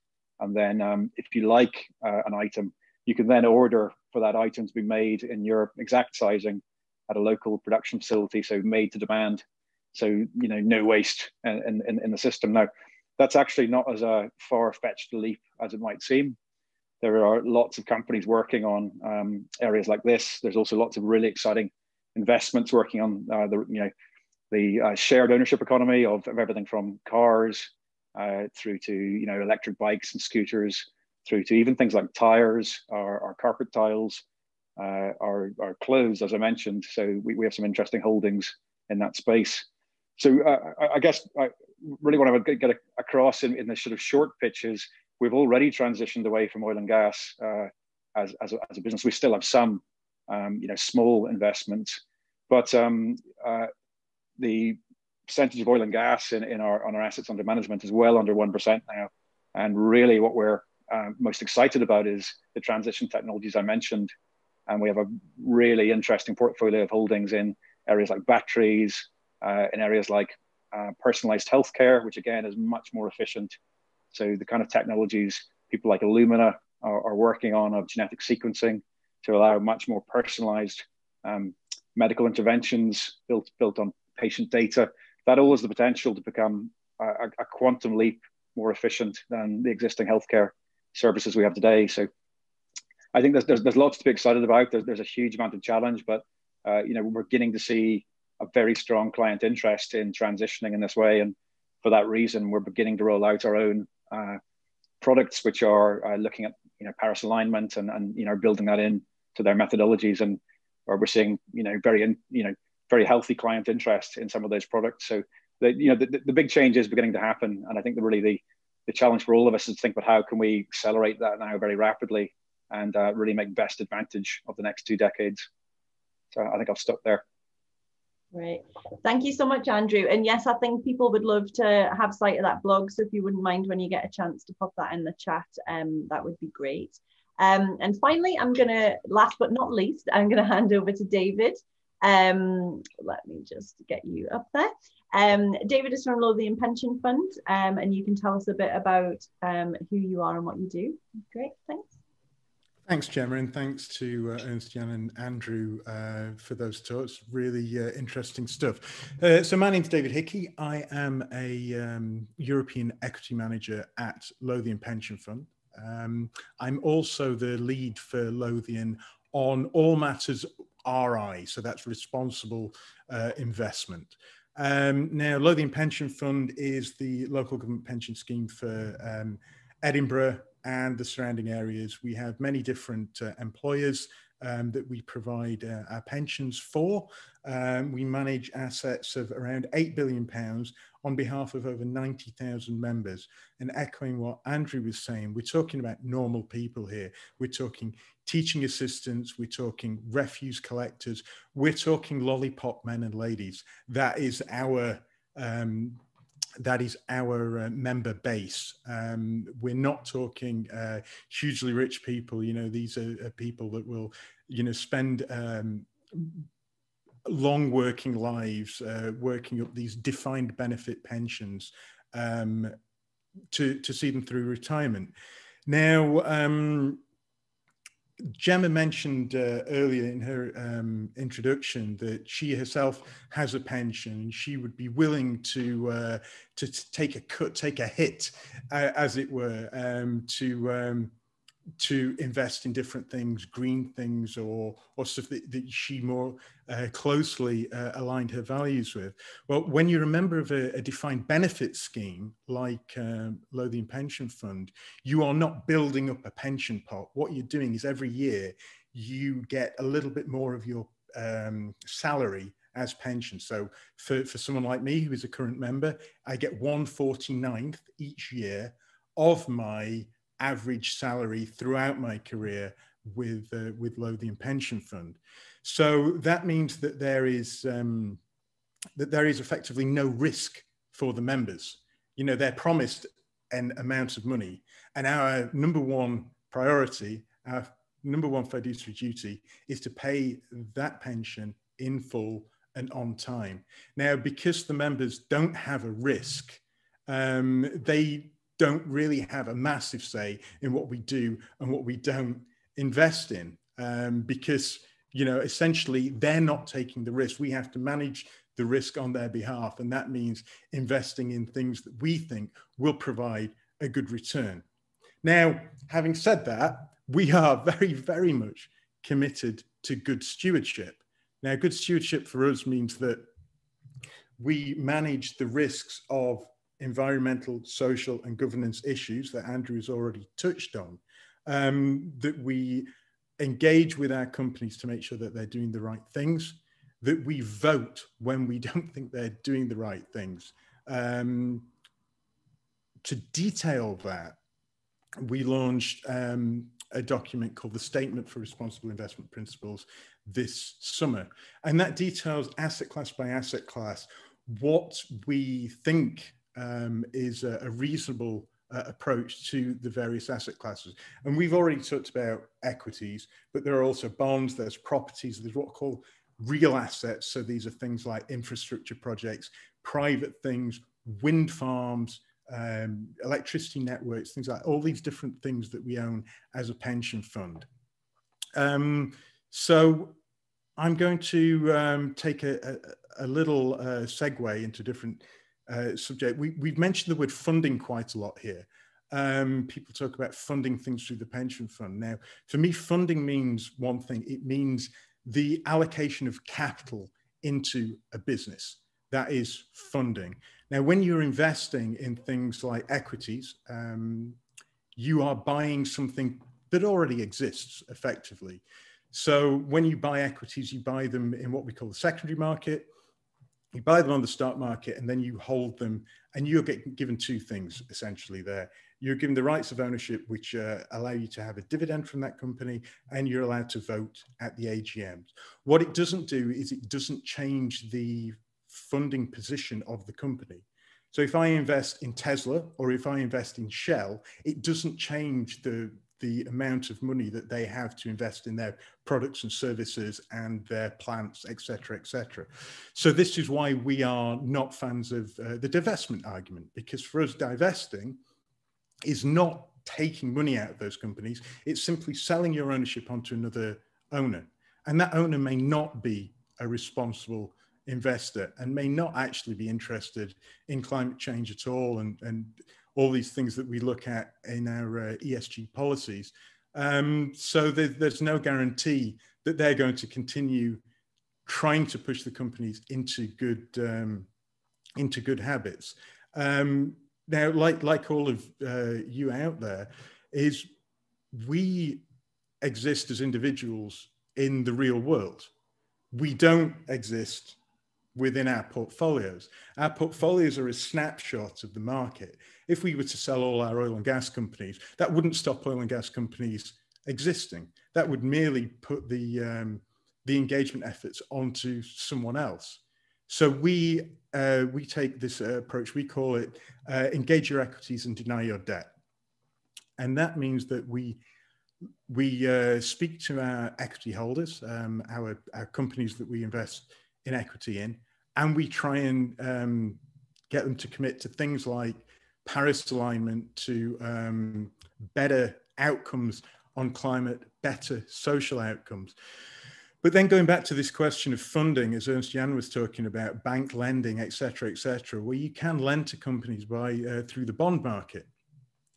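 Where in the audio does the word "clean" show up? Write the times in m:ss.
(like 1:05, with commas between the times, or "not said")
not said.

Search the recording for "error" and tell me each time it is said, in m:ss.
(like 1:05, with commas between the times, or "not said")
not said.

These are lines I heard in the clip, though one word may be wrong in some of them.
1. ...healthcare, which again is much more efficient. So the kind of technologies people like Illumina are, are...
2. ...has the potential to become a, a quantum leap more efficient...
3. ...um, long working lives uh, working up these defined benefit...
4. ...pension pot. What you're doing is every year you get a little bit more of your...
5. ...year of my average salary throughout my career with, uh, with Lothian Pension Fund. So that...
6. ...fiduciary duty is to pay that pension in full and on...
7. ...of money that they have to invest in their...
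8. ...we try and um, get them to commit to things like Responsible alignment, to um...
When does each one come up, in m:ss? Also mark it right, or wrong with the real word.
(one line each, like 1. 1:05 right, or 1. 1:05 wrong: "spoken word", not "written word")
1. 1:11 right
2. 1:25 right
3. 3:35 right
4. 4:16 right
5. 4:28 right
6. 4:48 right
7. 7:16 right
8. 8:38 wrong: "Paris", not "Responsible".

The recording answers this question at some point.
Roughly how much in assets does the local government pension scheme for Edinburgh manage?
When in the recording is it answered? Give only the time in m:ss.
3:09.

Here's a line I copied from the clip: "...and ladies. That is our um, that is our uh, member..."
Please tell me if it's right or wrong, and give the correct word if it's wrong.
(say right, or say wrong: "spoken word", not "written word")
right.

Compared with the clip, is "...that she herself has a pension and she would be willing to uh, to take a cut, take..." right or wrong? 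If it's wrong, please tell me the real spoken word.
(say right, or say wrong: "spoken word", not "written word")
right.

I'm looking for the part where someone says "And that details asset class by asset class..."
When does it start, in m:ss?
5:51.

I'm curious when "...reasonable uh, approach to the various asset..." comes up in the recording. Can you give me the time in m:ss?
5:57.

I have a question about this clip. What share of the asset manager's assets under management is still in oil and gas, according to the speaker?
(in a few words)
under 1 percent.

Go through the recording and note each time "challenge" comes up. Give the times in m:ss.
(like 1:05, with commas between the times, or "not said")
1:35, 1:58.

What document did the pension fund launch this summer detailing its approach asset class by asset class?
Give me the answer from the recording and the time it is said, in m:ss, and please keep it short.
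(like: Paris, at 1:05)
Statement for Responsible Investment Principles, at 5:47.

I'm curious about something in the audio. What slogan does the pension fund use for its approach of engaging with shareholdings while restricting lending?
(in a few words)
engage your equities and deny your debt.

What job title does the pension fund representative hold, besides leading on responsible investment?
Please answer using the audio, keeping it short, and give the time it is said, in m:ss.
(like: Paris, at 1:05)
European equity manager, at 2:42.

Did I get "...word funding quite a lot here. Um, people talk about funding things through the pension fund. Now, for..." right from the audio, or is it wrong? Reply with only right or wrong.
right.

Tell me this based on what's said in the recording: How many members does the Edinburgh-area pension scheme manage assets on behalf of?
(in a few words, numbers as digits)
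over 90,000.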